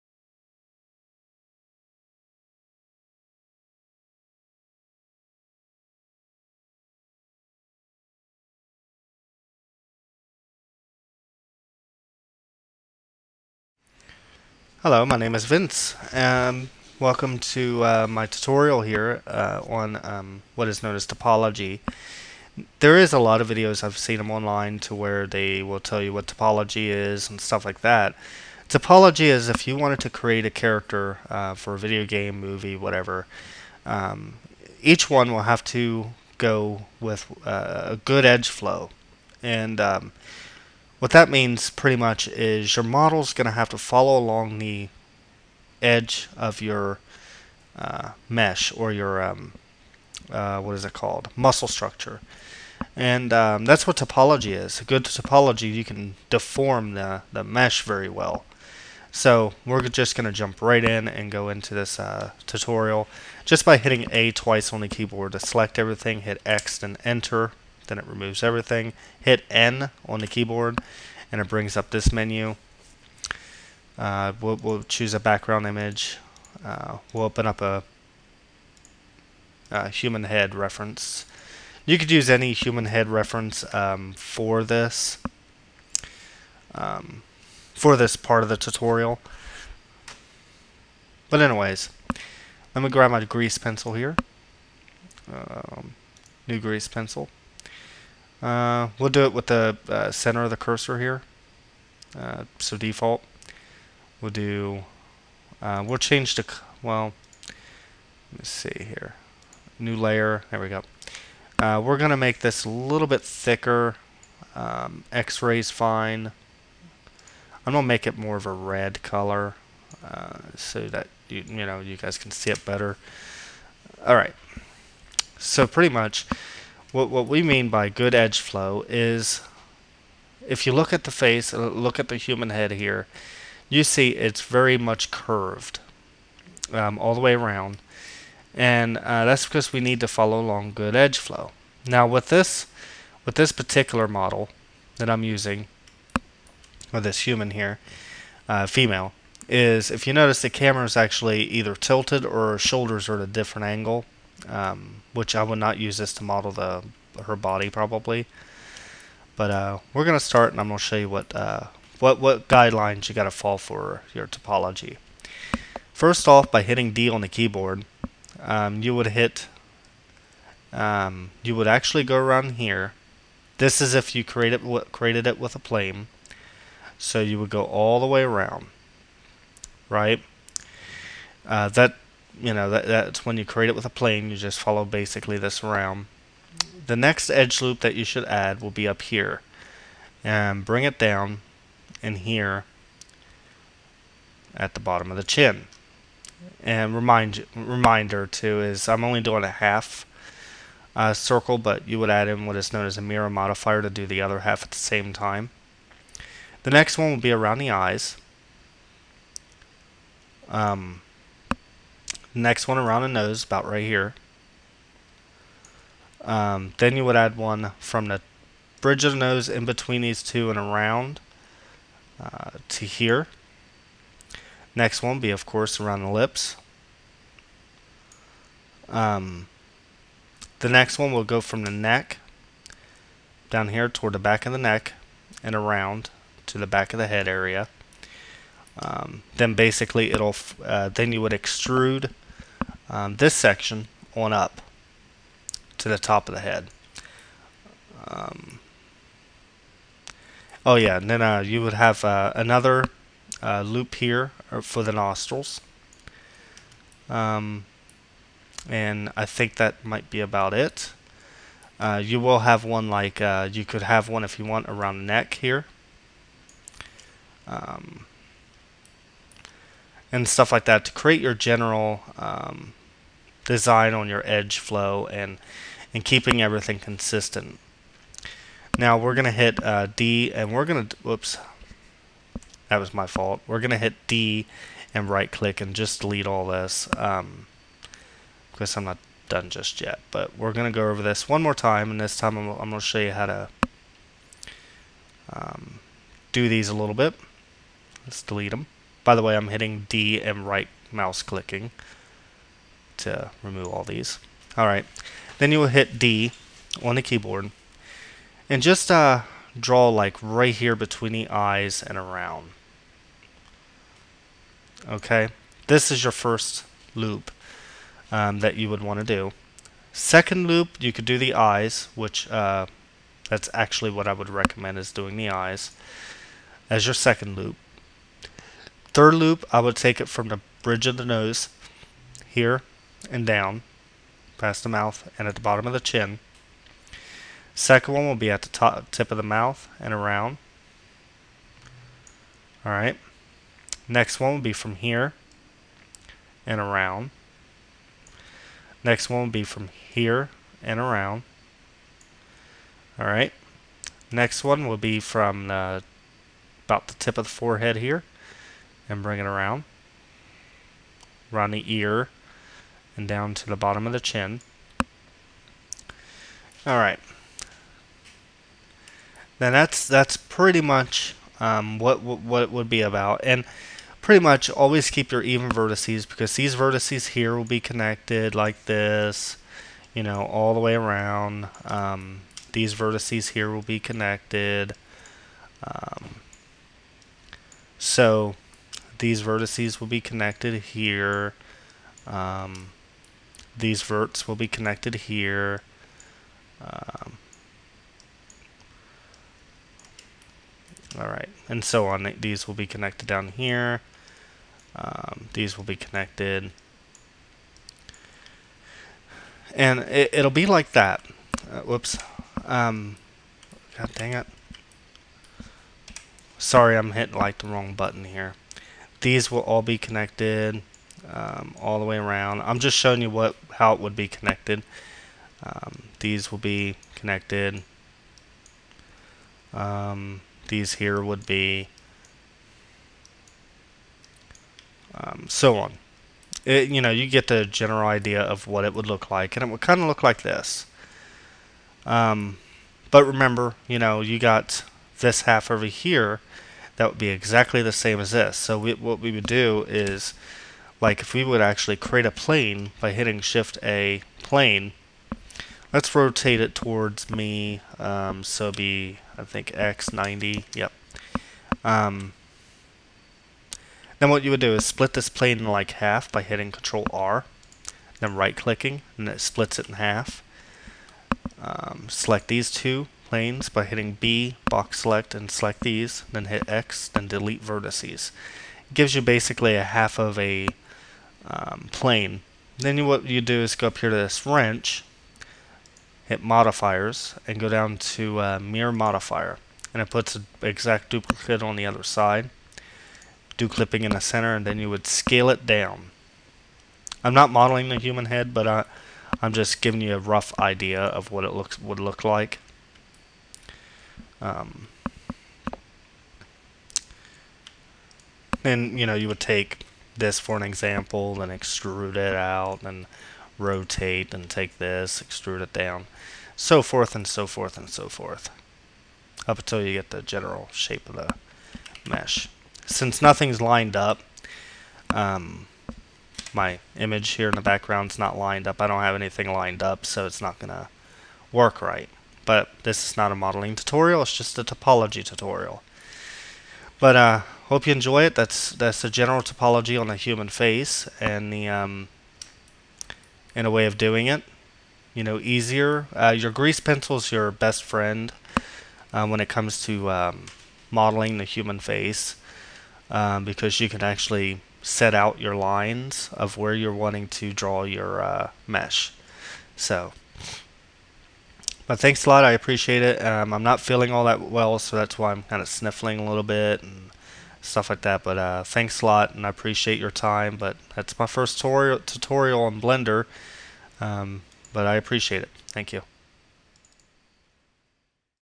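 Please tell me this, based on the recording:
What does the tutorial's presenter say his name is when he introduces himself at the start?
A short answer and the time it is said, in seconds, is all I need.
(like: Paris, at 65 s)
Vince, at 15 s.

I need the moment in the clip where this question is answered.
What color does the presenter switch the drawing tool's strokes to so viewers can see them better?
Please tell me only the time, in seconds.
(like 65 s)
118 s.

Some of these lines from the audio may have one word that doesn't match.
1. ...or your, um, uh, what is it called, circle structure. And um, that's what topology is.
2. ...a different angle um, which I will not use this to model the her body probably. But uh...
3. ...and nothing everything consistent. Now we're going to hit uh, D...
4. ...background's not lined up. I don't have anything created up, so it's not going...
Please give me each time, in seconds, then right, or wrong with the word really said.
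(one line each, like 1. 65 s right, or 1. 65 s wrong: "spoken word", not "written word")
1. 48 s wrong: "muscle", not "circle"
2. 153 s right
3. 275 s wrong: "keeping", not "nothing"
4. 527 s wrong: "lined", not "created".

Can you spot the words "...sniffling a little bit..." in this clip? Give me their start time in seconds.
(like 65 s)
565 s.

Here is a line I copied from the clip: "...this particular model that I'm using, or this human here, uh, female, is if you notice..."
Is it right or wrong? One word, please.
right.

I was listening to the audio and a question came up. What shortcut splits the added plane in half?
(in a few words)
Control R.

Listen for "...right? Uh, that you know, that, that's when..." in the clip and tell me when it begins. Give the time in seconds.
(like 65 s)
179 s.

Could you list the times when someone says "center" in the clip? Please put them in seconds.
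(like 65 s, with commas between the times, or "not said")
100 s, 494 s.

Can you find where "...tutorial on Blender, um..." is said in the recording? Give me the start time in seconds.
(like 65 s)
571 s.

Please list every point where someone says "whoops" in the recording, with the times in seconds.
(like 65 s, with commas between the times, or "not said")
280 s, 411 s.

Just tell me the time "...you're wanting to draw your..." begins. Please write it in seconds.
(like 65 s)
556 s.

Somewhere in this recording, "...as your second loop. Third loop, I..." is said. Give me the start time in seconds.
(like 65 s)
326 s.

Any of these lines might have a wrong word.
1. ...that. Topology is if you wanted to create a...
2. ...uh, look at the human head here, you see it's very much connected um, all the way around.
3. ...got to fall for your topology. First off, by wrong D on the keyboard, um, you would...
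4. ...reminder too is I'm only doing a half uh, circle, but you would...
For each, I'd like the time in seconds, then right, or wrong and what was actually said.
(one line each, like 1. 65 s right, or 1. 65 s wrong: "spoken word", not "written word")
1. 27 s right
2. 131 s wrong: "curved", not "connected"
3. 163 s wrong: "hitting", not "wrong"
4. 197 s right.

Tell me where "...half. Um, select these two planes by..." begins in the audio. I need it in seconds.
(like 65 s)
469 s.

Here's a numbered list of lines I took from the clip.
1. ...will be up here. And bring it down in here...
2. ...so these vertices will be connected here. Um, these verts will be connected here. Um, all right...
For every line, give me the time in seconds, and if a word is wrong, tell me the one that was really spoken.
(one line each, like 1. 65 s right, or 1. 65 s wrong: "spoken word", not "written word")
1. 188 s right
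2. 387 s right.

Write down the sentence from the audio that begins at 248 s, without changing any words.
Um, oh yeah, and then uh, you would have uh, another uh, loop here uh, for the nostrils.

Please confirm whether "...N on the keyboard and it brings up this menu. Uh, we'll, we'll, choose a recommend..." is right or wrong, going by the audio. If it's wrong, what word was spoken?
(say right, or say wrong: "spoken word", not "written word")
wrong: "background", not "recommend".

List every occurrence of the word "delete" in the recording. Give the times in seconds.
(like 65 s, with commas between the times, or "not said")
286 s, 298 s, 477 s.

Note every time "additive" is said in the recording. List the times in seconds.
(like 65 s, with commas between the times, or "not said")
not said.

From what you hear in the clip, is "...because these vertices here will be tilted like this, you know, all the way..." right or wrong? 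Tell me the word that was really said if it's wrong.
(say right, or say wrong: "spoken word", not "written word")
wrong: "connected", not "tilted".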